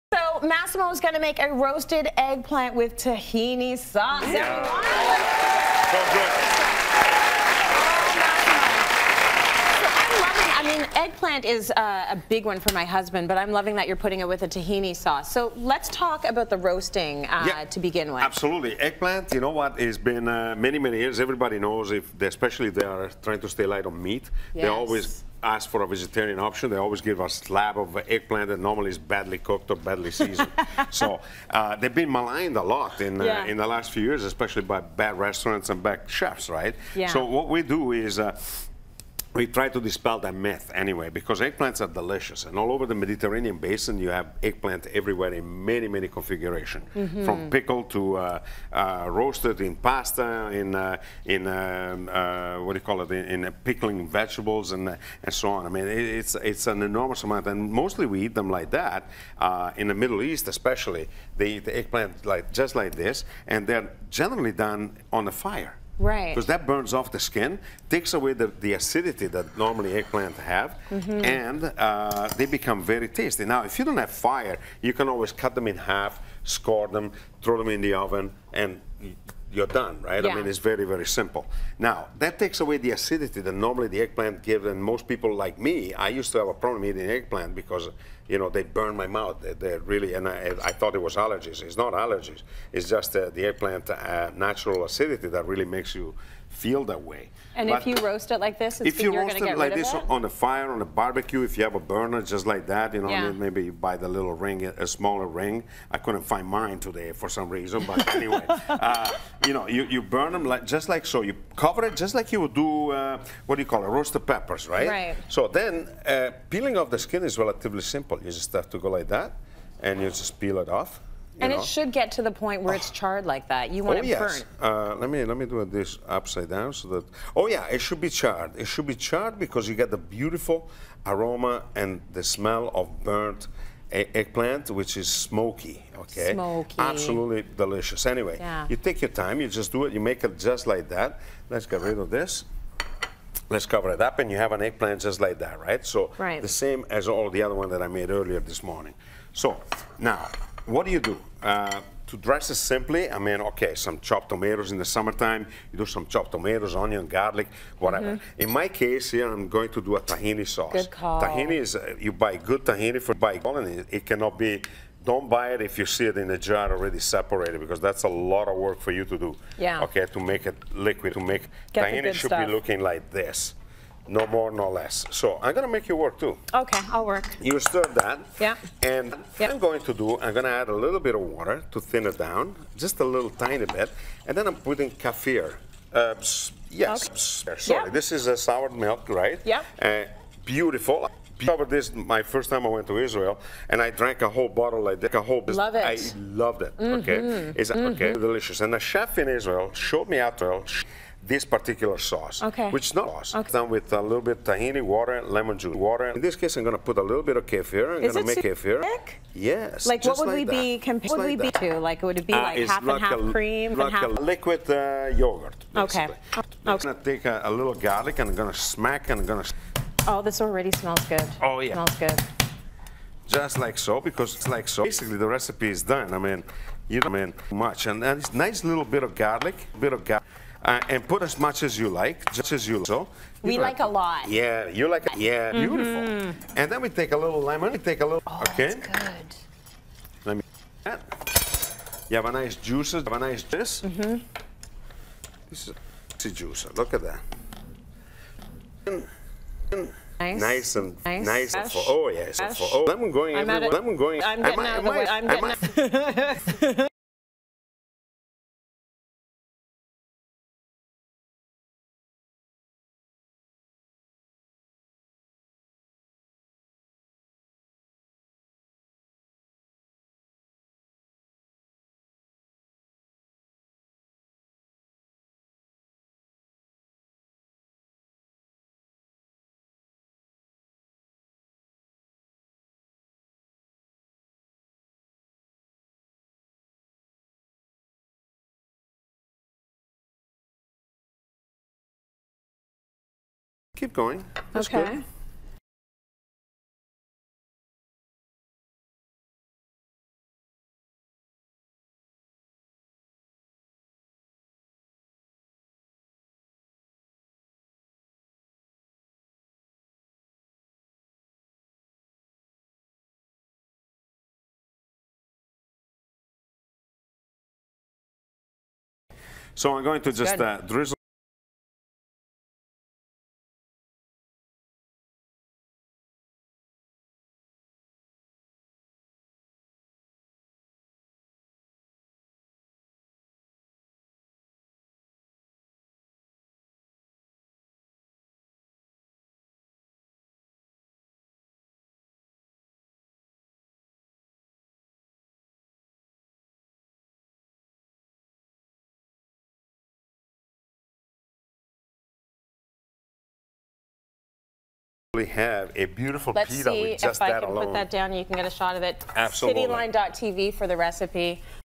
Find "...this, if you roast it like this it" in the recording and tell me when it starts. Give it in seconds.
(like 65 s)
98 s.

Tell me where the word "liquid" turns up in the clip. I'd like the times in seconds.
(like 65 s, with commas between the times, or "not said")
170 s, 214 s.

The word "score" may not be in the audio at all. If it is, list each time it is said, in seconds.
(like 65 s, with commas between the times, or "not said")
76 s.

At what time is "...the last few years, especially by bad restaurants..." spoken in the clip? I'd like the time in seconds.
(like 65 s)
33 s.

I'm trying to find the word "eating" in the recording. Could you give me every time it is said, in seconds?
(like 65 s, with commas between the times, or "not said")
86 s.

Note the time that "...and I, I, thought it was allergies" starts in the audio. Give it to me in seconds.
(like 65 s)
90 s.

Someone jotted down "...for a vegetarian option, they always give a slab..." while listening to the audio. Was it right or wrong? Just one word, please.
right.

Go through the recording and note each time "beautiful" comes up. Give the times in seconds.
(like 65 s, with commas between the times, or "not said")
129 s, 190 s, 235 s, 355 s.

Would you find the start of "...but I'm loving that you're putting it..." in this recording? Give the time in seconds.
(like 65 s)
13 s.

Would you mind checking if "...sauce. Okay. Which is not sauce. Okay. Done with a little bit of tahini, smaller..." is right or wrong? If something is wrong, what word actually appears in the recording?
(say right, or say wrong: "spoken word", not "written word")
wrong: "water", not "smaller".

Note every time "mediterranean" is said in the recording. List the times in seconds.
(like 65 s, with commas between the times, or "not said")
42 s.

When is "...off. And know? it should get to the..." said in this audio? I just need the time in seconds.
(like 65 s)
120 s.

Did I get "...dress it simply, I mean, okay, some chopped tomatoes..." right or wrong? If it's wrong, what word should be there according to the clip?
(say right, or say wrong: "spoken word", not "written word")
right.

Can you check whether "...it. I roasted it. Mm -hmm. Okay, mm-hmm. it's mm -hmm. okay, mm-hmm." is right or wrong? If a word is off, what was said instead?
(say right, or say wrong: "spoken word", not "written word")
wrong: "loved", not "roasted".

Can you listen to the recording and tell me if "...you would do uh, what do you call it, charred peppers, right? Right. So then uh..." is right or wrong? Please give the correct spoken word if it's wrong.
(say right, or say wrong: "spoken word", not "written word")
wrong: "roasted", not "charred".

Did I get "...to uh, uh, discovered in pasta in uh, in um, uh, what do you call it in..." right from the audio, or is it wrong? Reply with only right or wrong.
wrong.